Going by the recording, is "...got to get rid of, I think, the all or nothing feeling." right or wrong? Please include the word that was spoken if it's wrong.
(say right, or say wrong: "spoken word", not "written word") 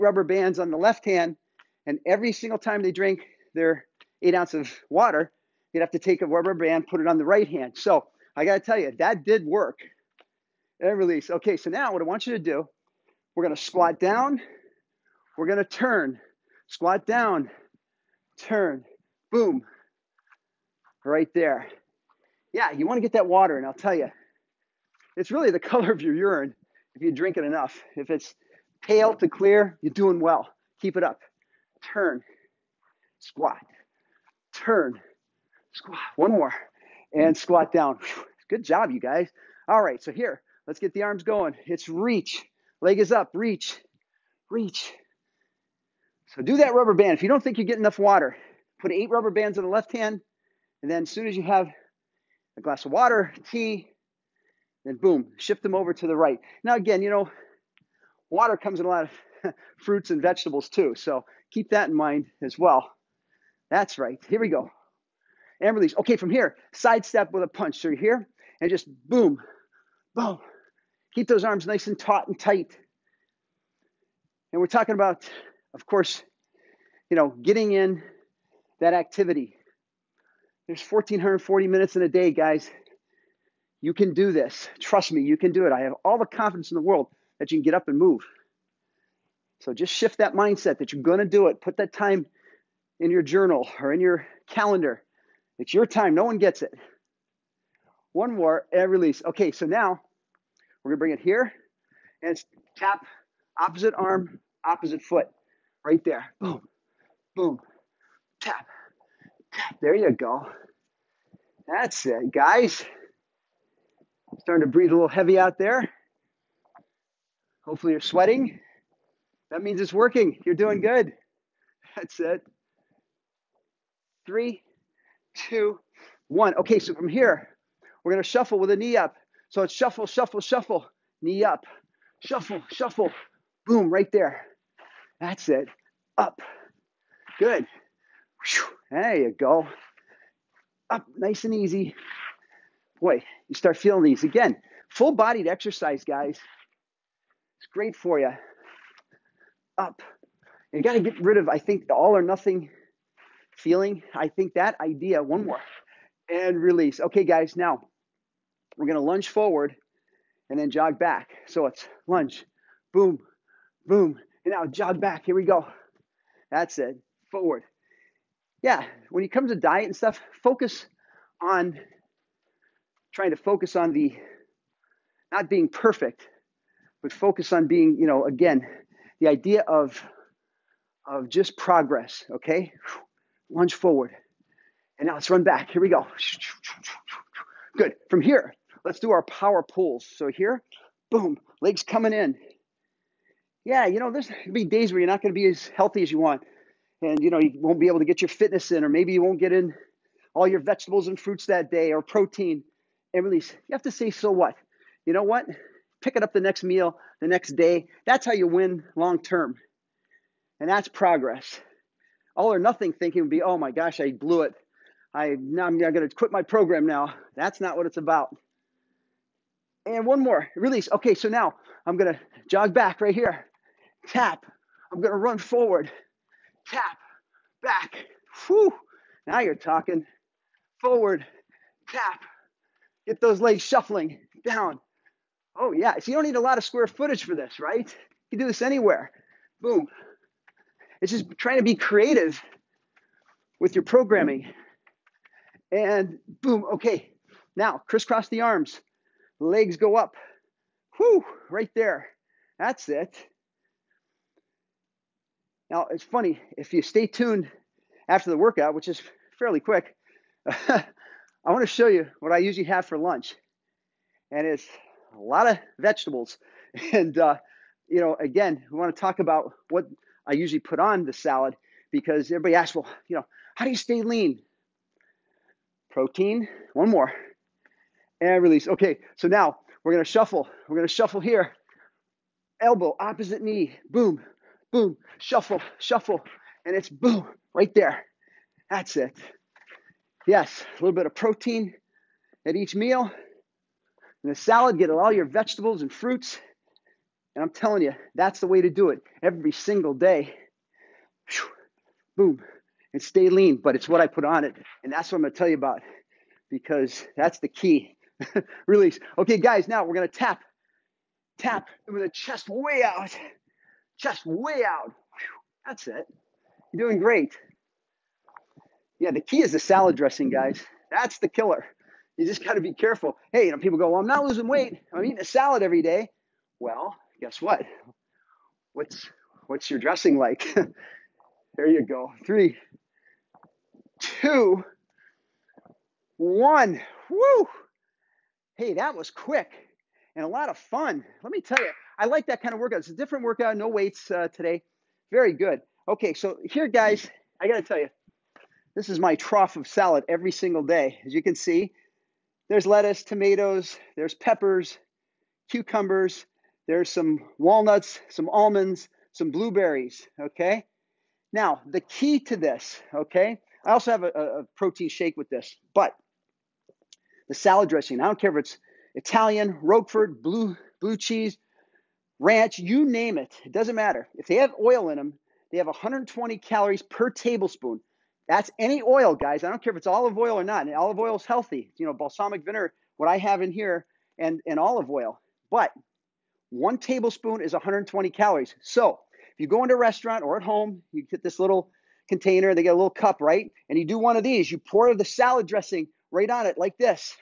right.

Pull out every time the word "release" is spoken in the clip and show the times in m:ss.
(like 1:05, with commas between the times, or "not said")
0:10, 1:05, 1:38, 2:36, 3:23, 3:40, 4:38, 5:08.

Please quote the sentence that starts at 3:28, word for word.
That's how you win long term, and that's progress.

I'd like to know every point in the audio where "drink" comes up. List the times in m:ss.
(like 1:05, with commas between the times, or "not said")
0:02, 0:27.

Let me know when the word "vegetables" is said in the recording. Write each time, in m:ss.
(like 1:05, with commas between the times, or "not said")
1:00, 3:20, 4:25, 4:55.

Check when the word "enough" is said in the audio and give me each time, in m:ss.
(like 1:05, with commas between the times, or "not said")
0:27, 0:47.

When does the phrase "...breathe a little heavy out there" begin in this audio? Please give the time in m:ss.
1:54.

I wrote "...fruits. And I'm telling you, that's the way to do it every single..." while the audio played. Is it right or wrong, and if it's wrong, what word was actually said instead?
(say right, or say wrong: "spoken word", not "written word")
right.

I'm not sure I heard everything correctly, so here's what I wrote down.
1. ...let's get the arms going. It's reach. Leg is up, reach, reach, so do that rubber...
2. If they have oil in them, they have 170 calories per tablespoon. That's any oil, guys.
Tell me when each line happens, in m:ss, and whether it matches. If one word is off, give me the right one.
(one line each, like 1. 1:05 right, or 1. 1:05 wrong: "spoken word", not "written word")
1. 0:40 right
2. 6:14 wrong: "120", not "170".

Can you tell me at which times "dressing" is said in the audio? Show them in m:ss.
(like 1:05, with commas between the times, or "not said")
5:19, 5:29, 6:07, 6:35.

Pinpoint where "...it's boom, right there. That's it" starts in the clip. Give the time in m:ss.
4:46.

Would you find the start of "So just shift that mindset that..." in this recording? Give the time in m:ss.
1:29.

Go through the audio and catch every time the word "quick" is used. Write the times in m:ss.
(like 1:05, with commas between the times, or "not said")
4:19, 5:39.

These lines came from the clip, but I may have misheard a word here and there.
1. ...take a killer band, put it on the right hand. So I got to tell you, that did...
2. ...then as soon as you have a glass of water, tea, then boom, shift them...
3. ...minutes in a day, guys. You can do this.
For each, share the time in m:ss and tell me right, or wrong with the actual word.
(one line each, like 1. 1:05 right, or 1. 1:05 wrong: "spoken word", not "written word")
1. 0:05 wrong: "rubber", not "killer"
2. 0:50 right
3. 1:21 right.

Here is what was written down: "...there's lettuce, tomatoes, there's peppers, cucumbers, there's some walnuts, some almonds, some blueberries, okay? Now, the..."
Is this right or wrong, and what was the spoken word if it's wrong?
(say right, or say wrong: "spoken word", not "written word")
right.